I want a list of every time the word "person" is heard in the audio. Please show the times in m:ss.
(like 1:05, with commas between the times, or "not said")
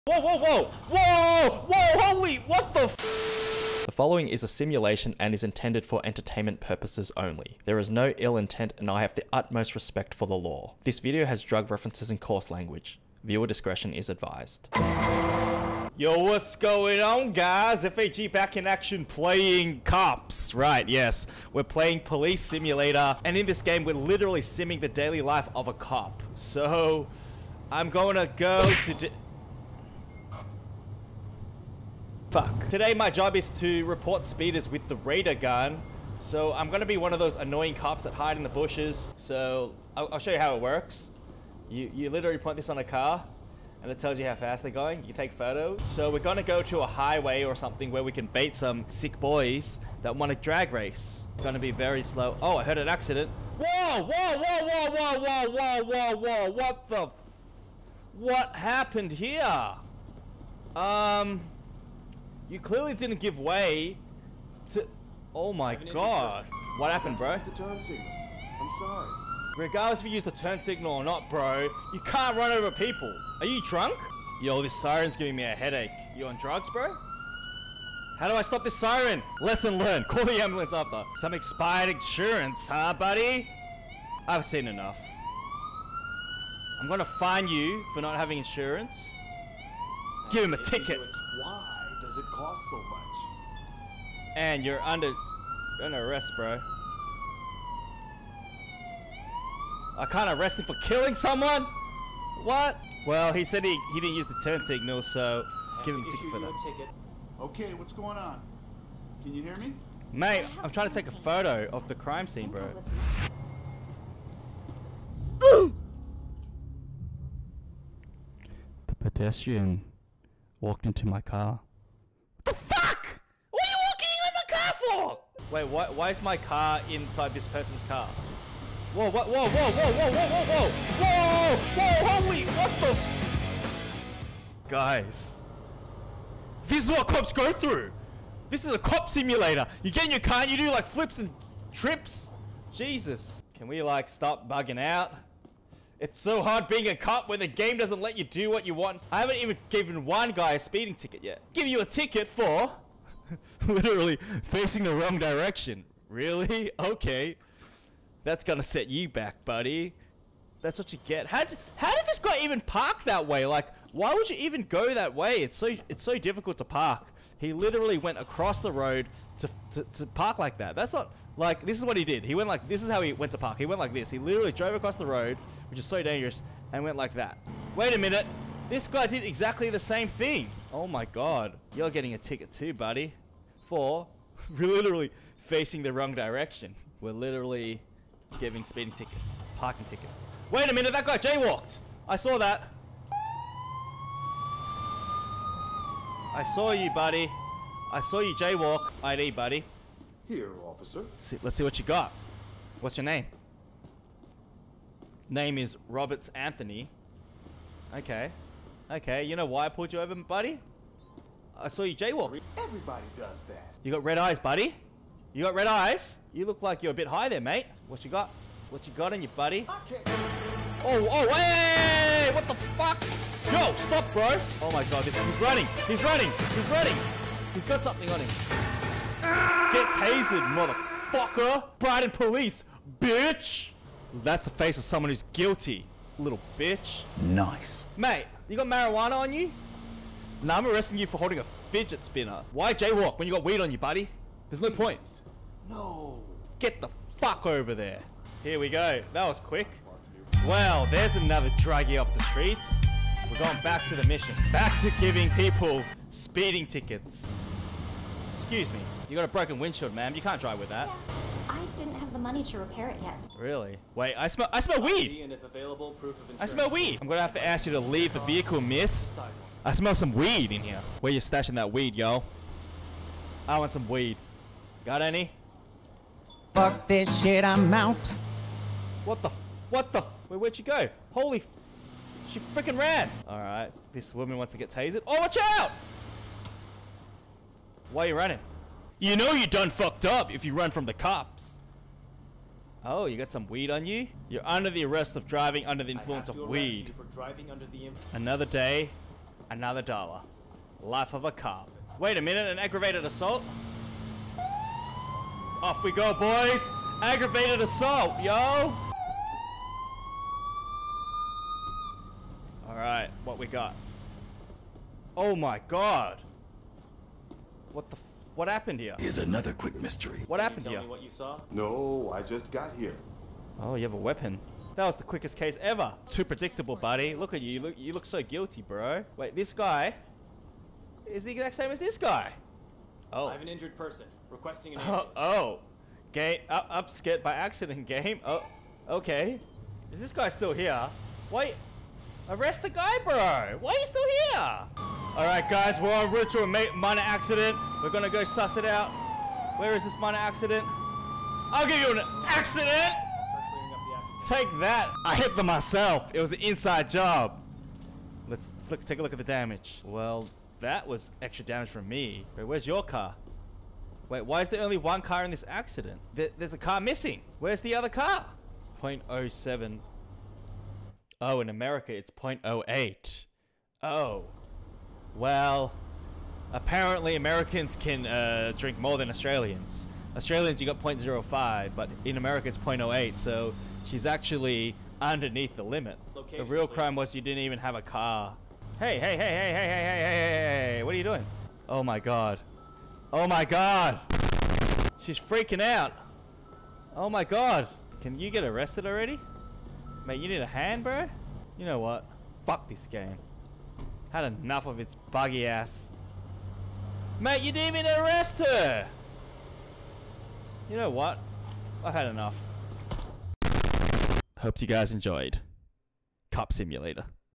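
2:07, 5:33.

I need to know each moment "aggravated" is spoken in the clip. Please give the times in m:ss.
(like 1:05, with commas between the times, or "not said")
5:02, 5:07.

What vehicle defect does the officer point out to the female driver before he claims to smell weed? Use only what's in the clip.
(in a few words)
broken windshield.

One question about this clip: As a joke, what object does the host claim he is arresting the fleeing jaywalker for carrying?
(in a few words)
fidget spinner.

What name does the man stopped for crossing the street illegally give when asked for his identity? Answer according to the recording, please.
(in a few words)
Roberts Anthony.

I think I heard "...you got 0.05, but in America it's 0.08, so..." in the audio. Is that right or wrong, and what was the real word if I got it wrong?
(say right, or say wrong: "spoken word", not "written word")
right.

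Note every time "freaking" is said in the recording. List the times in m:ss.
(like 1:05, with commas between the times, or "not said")
4:42, 6:35.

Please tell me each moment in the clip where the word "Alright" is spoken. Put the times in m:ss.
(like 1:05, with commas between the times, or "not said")
4:43, 5:12, 5:45.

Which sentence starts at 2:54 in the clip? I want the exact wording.
He literally drove across the road, which is so dangerous, and went like that.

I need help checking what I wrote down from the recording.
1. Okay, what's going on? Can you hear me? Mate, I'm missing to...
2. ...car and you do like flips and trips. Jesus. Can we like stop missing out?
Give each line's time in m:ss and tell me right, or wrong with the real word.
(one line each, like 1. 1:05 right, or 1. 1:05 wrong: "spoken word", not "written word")
1. 1:47 wrong: "trying", not "missing"
2. 2:20 wrong: "bugging", not "missing".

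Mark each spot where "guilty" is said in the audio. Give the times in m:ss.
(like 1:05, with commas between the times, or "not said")
3:55, 5:28.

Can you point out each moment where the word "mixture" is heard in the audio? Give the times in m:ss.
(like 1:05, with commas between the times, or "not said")
not said.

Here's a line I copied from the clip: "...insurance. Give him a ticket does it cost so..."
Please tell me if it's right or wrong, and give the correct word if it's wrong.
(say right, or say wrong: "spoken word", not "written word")
right.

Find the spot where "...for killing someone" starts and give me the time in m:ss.
1:40.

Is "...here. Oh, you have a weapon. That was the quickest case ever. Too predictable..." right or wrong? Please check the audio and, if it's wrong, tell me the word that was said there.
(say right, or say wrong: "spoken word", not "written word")
right.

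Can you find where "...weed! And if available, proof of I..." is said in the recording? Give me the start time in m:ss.
4:24.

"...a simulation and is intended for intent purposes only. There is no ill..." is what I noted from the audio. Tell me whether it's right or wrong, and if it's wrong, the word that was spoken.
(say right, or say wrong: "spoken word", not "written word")
wrong: "entertainment", not "intent".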